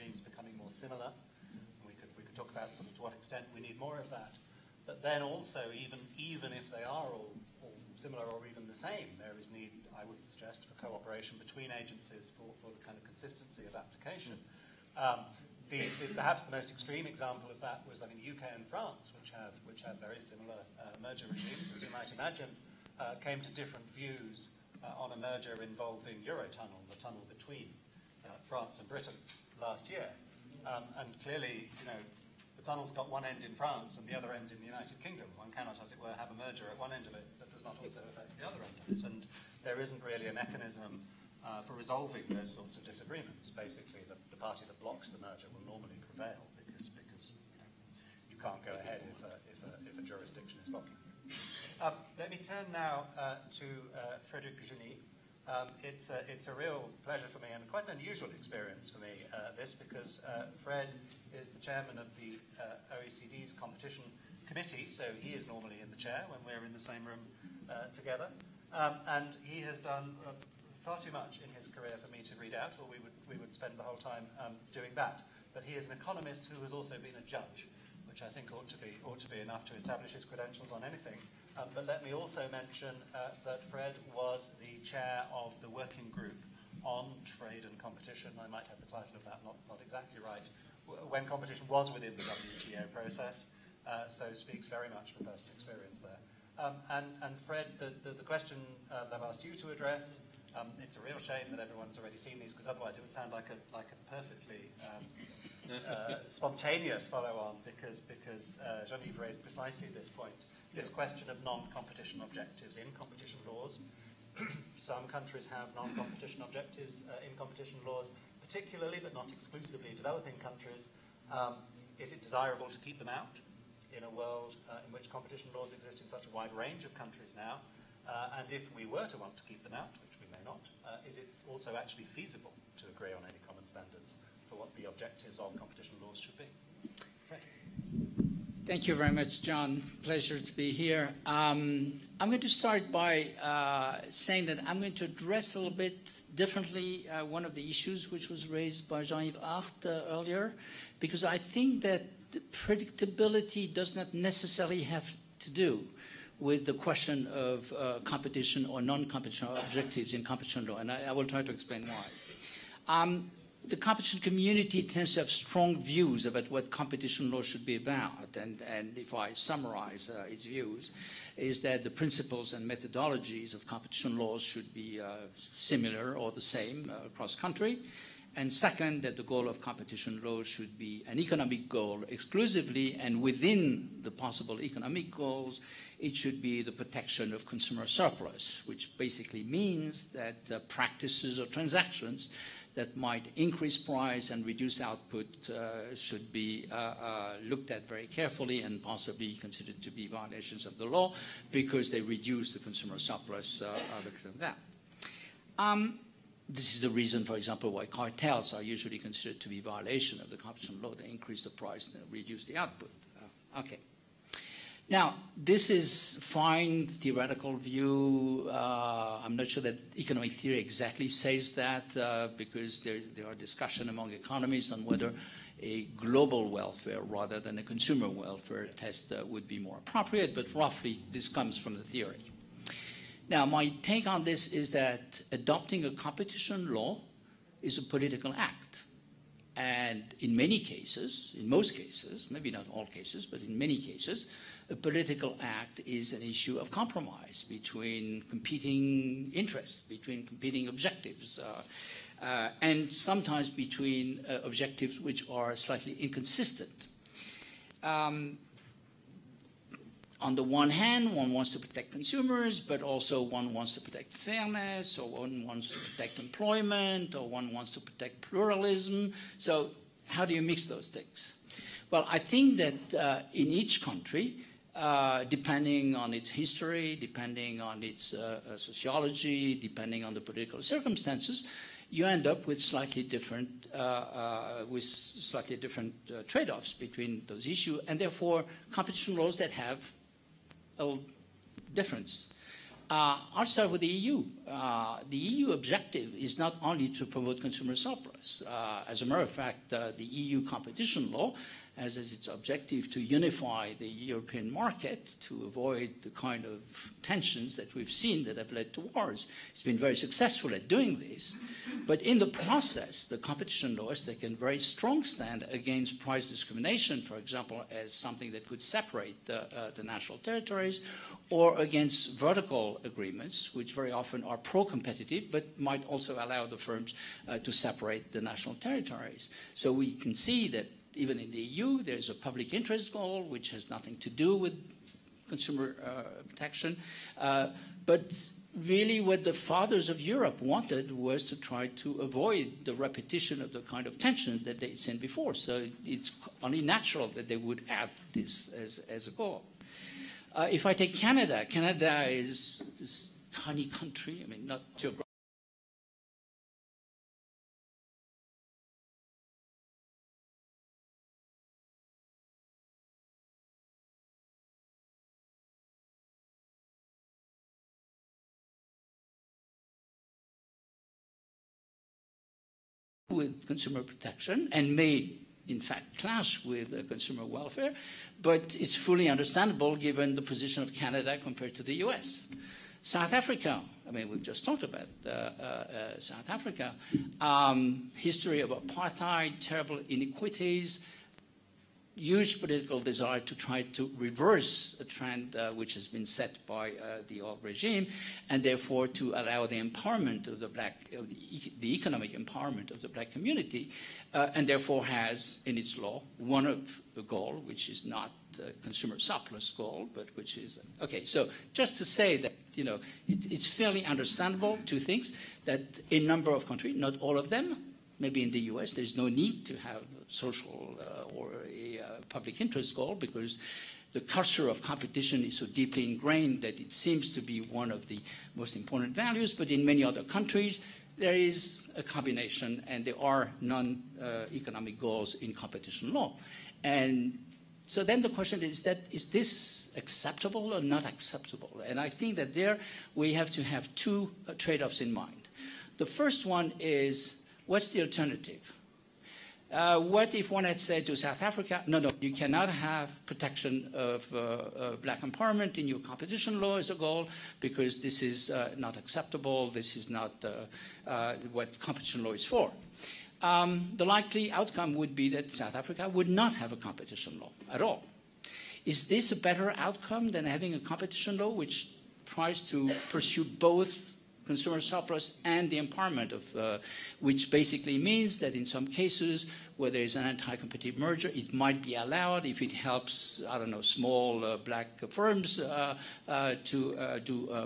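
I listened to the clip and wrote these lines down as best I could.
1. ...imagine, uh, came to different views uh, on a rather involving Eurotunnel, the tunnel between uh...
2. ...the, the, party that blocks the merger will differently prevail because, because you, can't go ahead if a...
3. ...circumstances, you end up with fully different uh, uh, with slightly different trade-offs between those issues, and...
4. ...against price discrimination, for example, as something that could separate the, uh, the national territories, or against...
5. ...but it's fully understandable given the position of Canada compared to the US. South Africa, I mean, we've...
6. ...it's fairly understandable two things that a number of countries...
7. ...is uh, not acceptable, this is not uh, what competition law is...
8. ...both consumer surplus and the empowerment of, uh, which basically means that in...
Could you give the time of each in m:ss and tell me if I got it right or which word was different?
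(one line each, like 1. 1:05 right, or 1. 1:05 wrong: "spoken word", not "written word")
1. 0:22 wrong: "merger", not "rather"
2. 0:44 wrong: "normally", not "differently"
3. 4:40 wrong: "slightly", not "fully"
4. 5:15 right
5. 6:18 right
6. 6:53 right
7. 7:38 right
8. 7:53 right.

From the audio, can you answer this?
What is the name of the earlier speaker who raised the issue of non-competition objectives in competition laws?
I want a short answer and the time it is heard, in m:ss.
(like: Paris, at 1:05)
Jean-Yves Art, at 2:29.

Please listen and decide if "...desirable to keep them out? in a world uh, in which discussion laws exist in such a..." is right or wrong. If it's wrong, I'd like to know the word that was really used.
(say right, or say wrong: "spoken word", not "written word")
wrong: "competition", not "discussion".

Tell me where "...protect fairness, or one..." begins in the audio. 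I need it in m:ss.
4:23.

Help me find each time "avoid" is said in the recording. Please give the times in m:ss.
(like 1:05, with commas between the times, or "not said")
5:05, 5:42.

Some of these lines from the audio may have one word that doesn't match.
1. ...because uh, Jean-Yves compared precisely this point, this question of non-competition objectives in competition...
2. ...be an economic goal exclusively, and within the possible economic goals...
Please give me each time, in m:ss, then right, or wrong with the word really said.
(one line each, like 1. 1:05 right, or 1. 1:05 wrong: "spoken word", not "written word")
1. 1:48 wrong: "raised", not "compared"
2. 3:00 right.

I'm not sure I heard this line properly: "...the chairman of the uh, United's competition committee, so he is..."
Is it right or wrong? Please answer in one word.
wrong.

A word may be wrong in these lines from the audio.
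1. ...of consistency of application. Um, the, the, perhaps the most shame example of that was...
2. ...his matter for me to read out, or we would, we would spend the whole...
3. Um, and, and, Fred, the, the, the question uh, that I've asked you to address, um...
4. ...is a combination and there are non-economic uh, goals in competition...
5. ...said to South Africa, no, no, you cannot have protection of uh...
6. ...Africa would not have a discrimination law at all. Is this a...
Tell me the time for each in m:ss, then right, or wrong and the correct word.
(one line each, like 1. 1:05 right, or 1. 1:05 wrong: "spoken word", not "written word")
1. 0:12 wrong: "extreme", not "shame"
2. 1:11 wrong: "career", not "matter"
3. 1:36 right
4. 7:11 right
5. 7:30 right
6. 7:45 wrong: "competition", not "discrimination".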